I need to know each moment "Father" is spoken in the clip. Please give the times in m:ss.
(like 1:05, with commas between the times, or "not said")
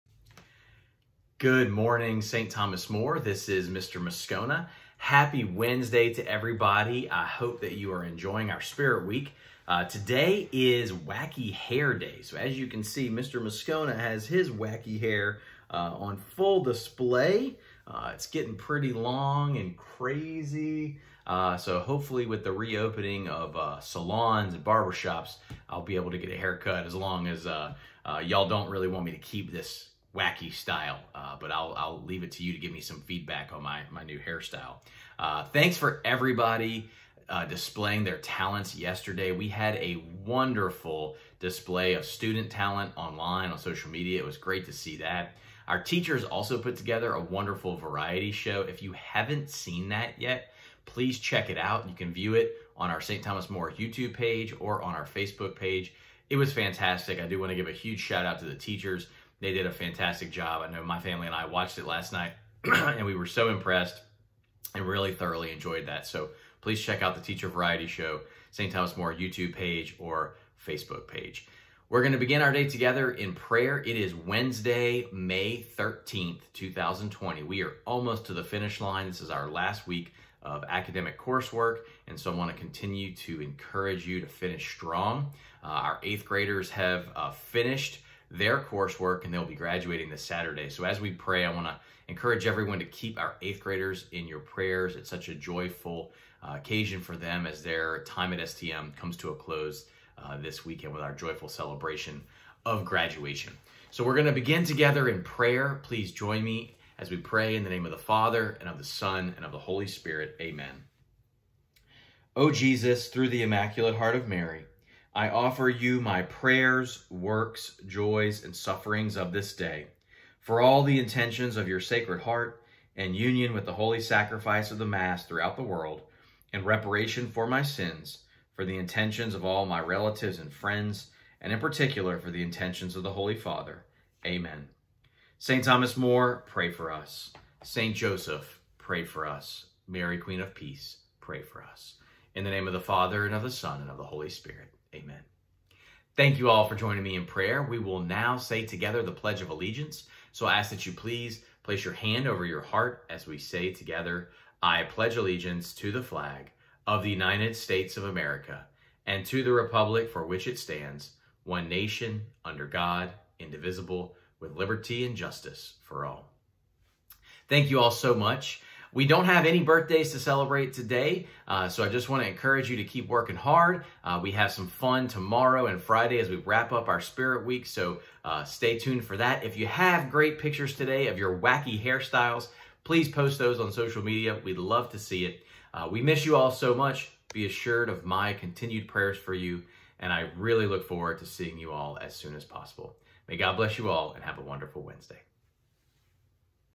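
1:47, 2:13, 2:22.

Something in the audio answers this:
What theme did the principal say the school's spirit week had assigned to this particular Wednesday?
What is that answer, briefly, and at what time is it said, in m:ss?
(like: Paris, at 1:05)
Wacky Hair Day, at 0:10.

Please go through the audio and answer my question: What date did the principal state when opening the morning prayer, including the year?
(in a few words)
Wednesday, May 13th, 2020.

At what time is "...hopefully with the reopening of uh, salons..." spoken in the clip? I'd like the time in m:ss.
0:21.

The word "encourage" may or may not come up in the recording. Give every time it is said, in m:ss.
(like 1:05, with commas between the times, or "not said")
1:23, 1:32, 2:52.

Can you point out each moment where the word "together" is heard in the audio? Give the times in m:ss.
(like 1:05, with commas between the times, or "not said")
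0:46, 1:12, 1:44, 2:28, 2:33.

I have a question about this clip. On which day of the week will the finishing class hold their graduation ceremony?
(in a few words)
Saturday.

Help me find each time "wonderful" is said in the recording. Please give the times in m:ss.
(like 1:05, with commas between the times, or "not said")
0:40, 0:47, 3:14.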